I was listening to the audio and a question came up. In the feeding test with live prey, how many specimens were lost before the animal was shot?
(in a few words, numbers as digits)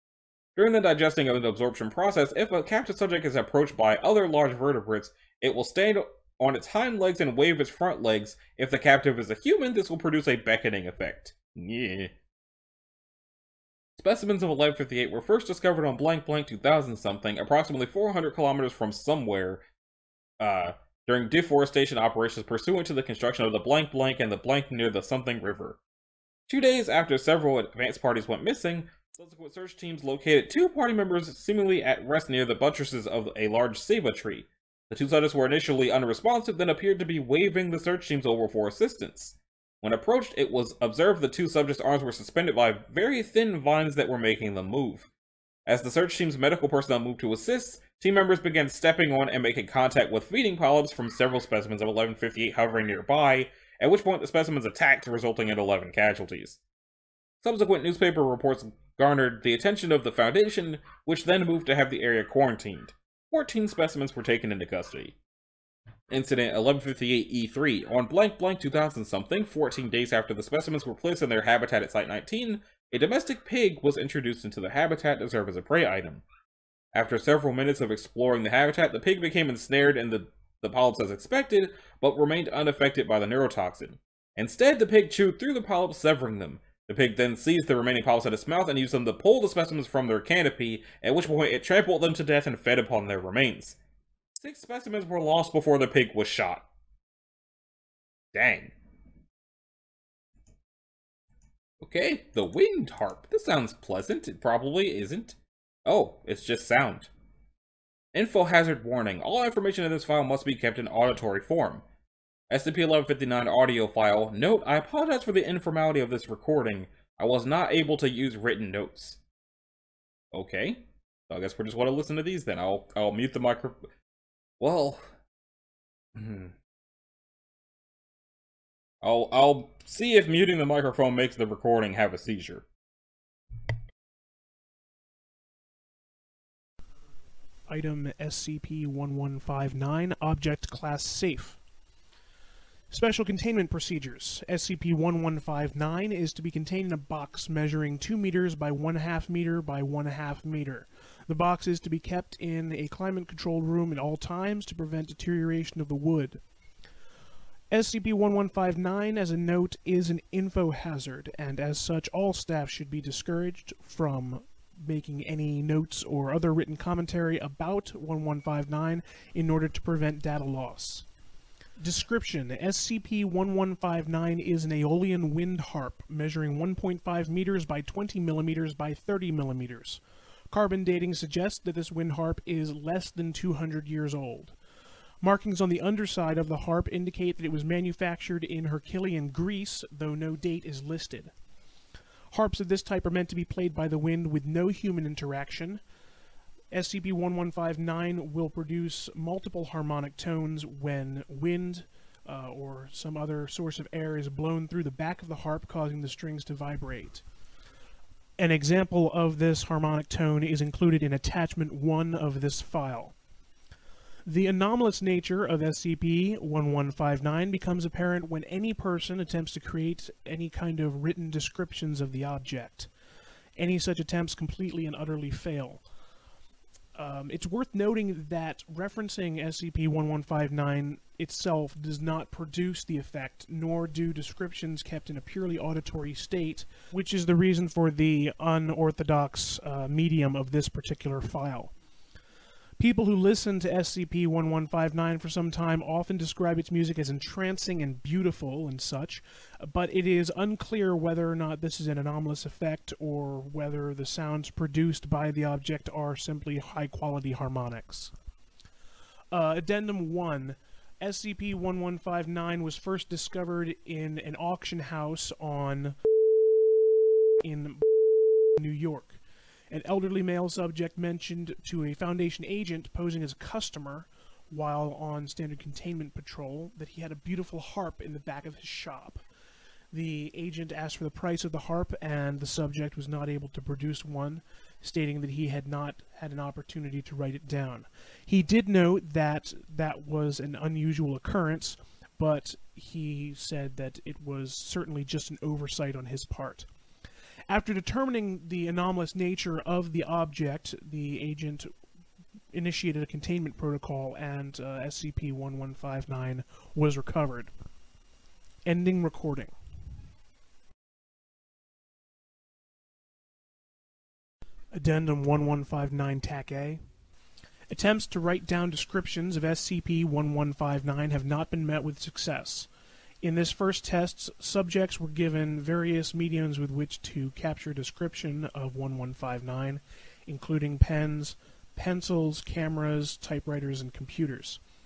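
6.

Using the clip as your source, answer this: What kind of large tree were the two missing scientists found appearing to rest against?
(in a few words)
ceiba.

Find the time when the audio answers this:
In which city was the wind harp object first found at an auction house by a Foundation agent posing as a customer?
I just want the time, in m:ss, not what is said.
4:28.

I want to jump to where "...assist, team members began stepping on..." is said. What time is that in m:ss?
0:47.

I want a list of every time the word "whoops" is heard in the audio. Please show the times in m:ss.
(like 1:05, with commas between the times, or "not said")
not said.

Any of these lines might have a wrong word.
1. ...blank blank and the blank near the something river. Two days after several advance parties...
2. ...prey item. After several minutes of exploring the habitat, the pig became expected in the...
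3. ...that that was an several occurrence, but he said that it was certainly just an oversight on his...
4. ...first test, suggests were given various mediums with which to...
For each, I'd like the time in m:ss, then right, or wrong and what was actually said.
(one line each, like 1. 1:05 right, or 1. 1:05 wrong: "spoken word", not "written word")
1. 0:23 right
2. 1:15 wrong: "ensnared", not "expected"
3. 4:49 wrong: "unusual", not "several"
4. 5:23 wrong: "subjects", not "suggests".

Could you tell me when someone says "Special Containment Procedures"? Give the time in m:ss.
2:22.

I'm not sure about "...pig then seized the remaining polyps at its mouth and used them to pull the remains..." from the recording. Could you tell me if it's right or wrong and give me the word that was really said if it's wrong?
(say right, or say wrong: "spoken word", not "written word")
wrong: "specimens", not "remains".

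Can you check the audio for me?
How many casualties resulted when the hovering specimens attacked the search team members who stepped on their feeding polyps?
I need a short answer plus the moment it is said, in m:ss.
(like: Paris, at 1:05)
11, at 0:55.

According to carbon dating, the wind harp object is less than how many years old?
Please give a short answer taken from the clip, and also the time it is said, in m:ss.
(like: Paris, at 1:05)
200, at 3:03.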